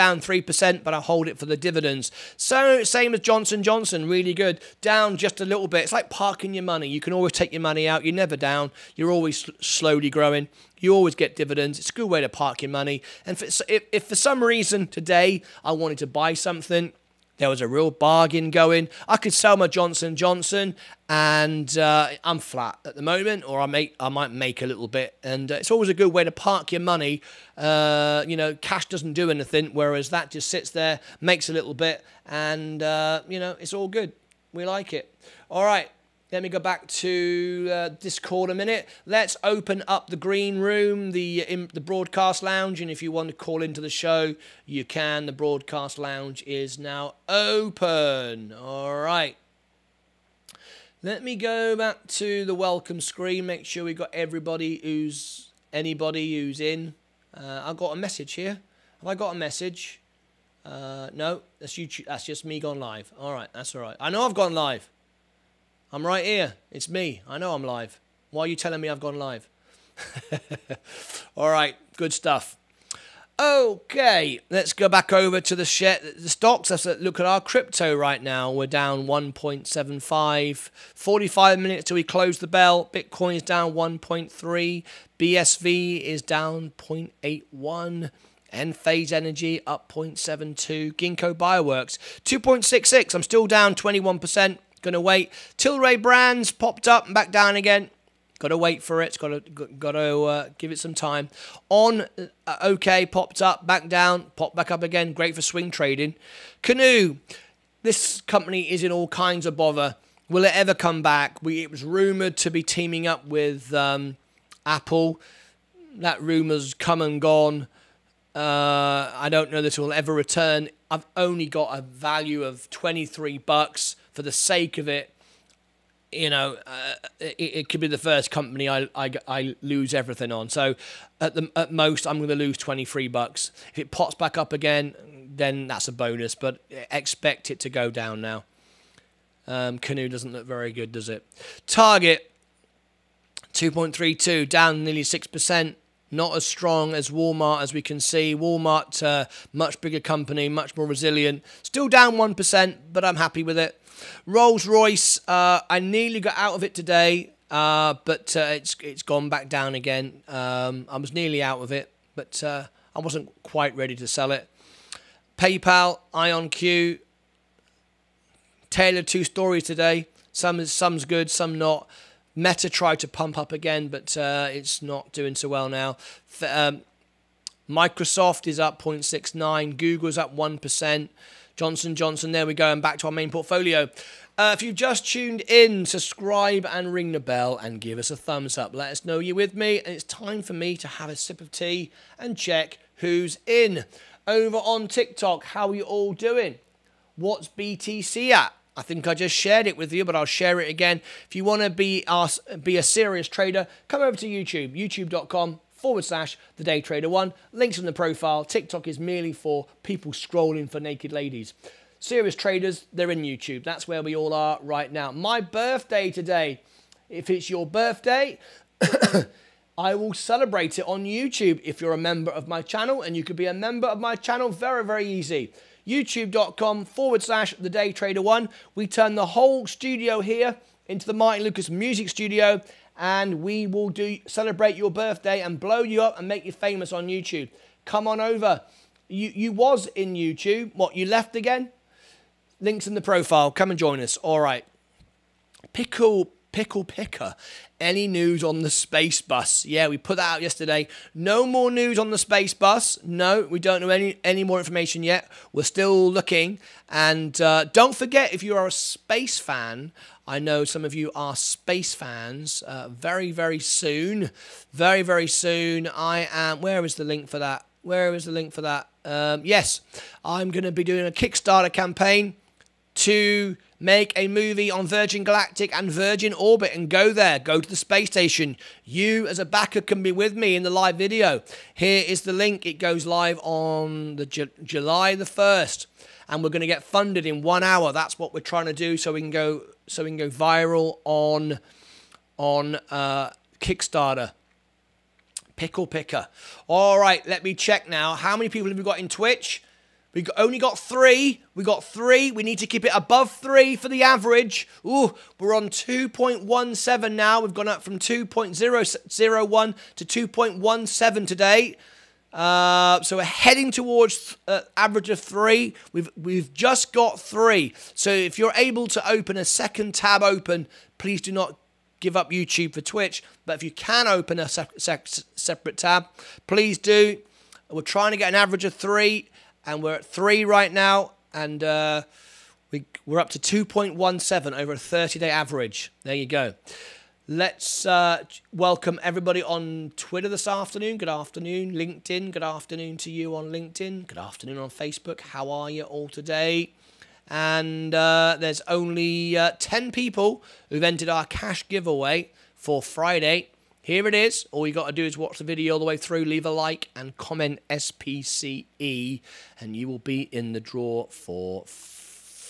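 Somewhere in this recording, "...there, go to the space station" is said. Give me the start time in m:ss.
4:37.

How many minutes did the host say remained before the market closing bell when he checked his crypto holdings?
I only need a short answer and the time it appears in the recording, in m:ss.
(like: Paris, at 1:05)
45, at 1:20.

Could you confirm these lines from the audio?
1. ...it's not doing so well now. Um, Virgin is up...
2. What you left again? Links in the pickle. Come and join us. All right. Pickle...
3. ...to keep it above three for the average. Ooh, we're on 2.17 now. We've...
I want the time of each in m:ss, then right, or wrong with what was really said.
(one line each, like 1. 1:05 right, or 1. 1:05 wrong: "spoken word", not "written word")
1. 2:54 wrong: "Microsoft", not "Virgin"
2. 4:00 wrong: "profile", not "pickle"
3. 5:02 right.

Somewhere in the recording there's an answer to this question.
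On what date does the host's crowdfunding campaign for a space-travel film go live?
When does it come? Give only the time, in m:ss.
4:44.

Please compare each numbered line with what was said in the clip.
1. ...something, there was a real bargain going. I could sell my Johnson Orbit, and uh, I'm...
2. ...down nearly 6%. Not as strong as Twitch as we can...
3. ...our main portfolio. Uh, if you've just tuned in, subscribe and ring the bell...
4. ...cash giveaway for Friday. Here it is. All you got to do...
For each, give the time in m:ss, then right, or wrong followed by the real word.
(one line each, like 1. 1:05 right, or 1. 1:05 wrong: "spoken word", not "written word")
1. 0:16 wrong: "Johnson", not "Orbit"
2. 2:24 wrong: "Walmart", not "Twitch"
3. 3:03 right
4. 5:51 right.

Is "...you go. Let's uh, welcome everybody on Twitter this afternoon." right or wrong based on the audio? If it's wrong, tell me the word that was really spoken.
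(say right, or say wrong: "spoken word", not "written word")
right.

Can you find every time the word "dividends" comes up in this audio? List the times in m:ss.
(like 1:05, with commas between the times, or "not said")
0:01, 0:11.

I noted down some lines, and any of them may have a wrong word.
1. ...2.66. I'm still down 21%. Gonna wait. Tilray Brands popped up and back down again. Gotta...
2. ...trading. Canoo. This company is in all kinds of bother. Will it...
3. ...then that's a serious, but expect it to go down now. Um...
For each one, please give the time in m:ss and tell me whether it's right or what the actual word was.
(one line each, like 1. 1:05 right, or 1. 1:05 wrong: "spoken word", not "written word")
1. 1:32 right
2. 1:45 right
3. 2:15 wrong: "bonus", not "serious".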